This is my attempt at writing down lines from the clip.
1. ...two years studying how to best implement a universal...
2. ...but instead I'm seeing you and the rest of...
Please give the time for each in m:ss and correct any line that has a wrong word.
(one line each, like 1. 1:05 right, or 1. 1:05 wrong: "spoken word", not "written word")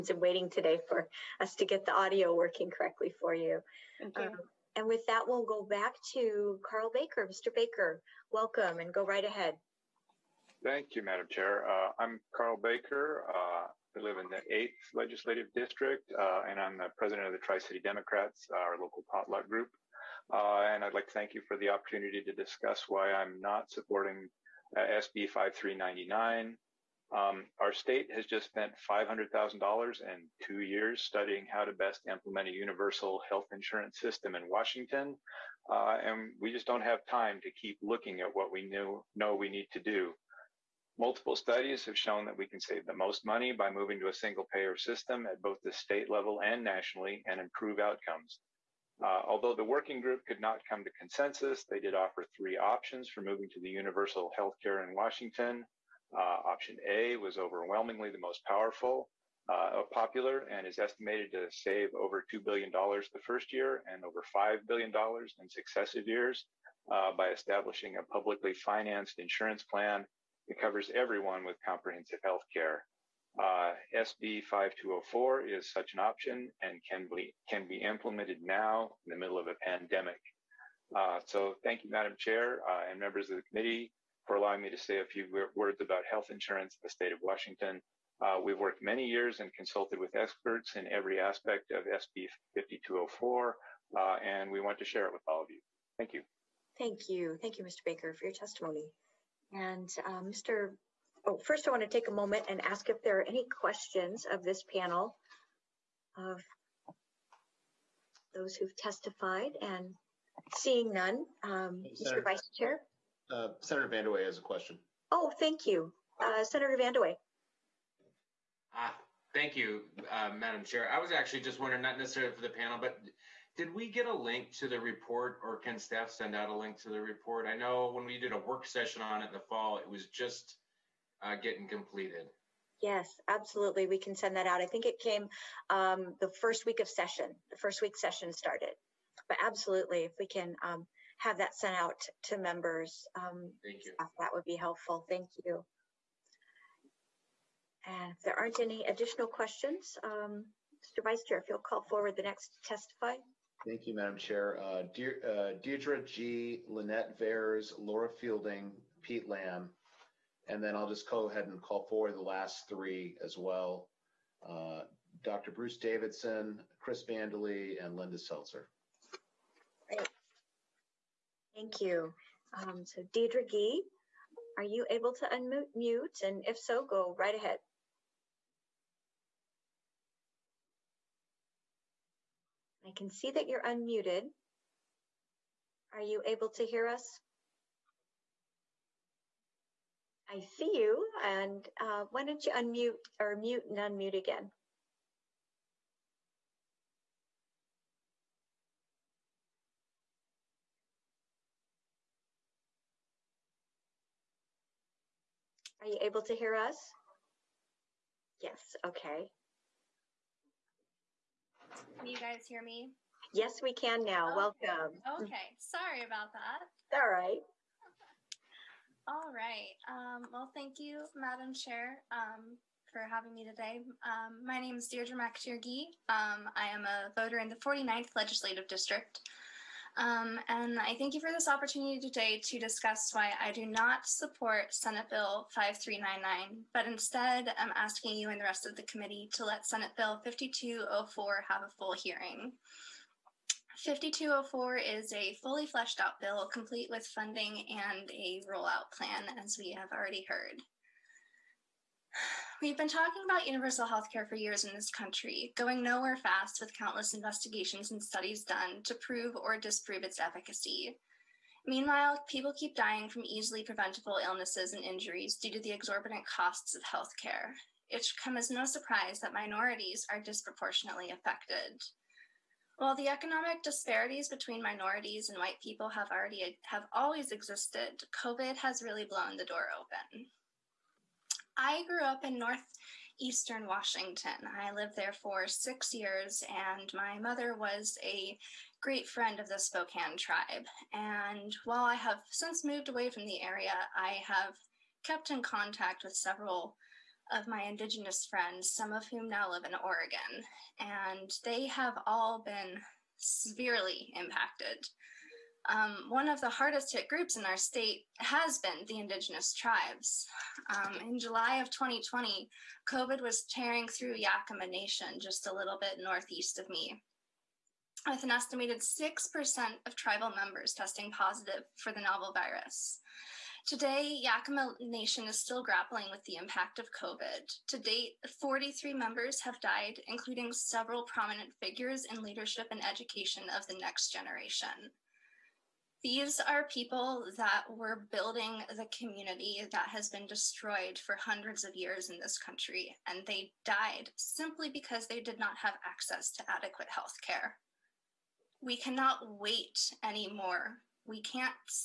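1. 0:30 right
2. 3:56 wrong: "asking", not "seeing".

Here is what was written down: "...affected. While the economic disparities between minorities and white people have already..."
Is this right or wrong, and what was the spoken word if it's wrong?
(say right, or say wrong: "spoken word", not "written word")
right.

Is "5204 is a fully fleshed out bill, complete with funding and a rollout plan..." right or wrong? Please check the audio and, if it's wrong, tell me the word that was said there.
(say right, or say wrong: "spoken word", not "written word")
right.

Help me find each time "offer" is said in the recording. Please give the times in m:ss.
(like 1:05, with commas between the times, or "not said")
0:51.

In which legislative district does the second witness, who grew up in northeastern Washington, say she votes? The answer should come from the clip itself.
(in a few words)
49th.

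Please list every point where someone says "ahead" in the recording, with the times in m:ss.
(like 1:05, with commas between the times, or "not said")
0:09, 2:41, 2:57.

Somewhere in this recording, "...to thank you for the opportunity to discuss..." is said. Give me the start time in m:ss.
0:21.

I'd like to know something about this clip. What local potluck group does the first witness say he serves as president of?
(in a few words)
Tri City Democrats.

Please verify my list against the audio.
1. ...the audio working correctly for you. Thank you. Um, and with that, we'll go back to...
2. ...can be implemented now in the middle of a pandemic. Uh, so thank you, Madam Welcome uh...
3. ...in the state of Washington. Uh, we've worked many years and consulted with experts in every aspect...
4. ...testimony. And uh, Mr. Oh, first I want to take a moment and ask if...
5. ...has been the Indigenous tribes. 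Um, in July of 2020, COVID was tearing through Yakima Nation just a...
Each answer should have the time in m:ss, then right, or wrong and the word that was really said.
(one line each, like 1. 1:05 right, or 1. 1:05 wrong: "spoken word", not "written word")
1. 0:01 right
2. 1:17 wrong: "Chair", not "Welcome"
3. 1:26 right
4. 1:38 right
5. 5:08 right.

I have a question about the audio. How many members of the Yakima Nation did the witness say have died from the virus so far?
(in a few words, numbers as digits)
43.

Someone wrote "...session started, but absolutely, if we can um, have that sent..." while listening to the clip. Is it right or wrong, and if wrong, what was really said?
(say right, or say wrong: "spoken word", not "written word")
right.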